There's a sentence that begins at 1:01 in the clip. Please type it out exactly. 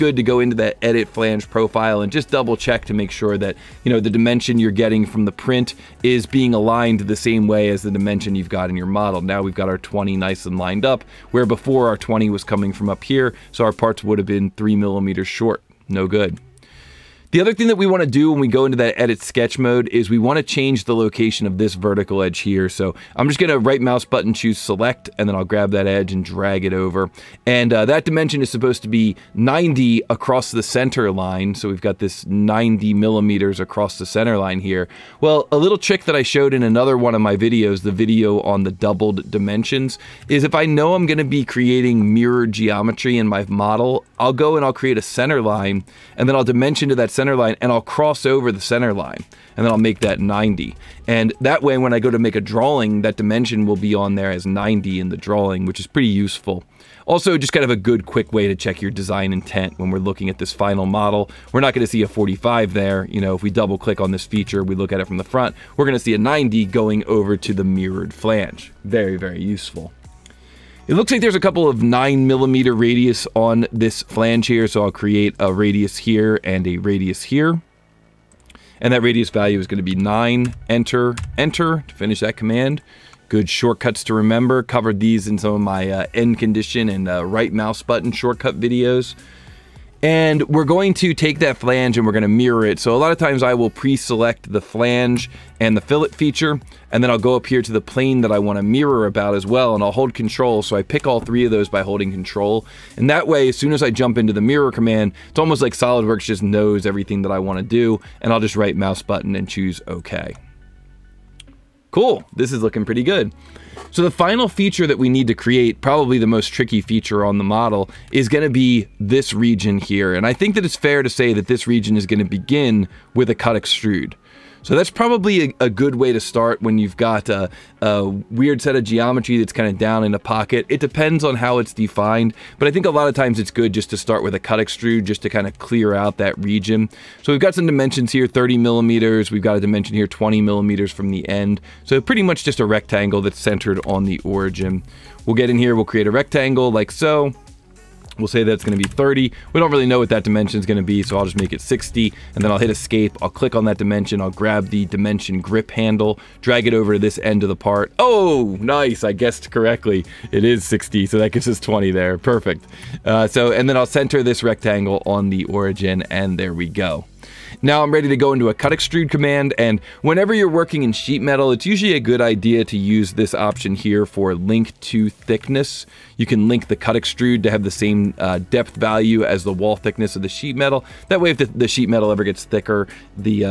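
We're not going to see a 45 there.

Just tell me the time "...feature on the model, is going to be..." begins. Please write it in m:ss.
1:56.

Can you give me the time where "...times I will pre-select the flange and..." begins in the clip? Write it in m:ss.
1:33.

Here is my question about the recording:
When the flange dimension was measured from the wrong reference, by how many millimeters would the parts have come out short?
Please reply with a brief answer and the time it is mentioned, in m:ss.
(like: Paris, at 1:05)
3 millimeters, at 0:14.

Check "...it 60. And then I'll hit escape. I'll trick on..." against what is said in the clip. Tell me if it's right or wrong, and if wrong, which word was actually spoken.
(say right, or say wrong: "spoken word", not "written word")
wrong: "click", not "trick".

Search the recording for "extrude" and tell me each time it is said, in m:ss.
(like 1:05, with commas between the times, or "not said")
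2:03, 2:14, 2:48, 2:56.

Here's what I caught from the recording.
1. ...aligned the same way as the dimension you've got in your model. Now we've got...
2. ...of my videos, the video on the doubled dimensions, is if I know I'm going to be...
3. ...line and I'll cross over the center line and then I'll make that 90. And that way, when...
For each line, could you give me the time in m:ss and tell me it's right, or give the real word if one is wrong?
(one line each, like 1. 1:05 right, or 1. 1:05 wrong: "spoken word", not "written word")
1. 0:06 right
2. 0:37 right
3. 0:47 right.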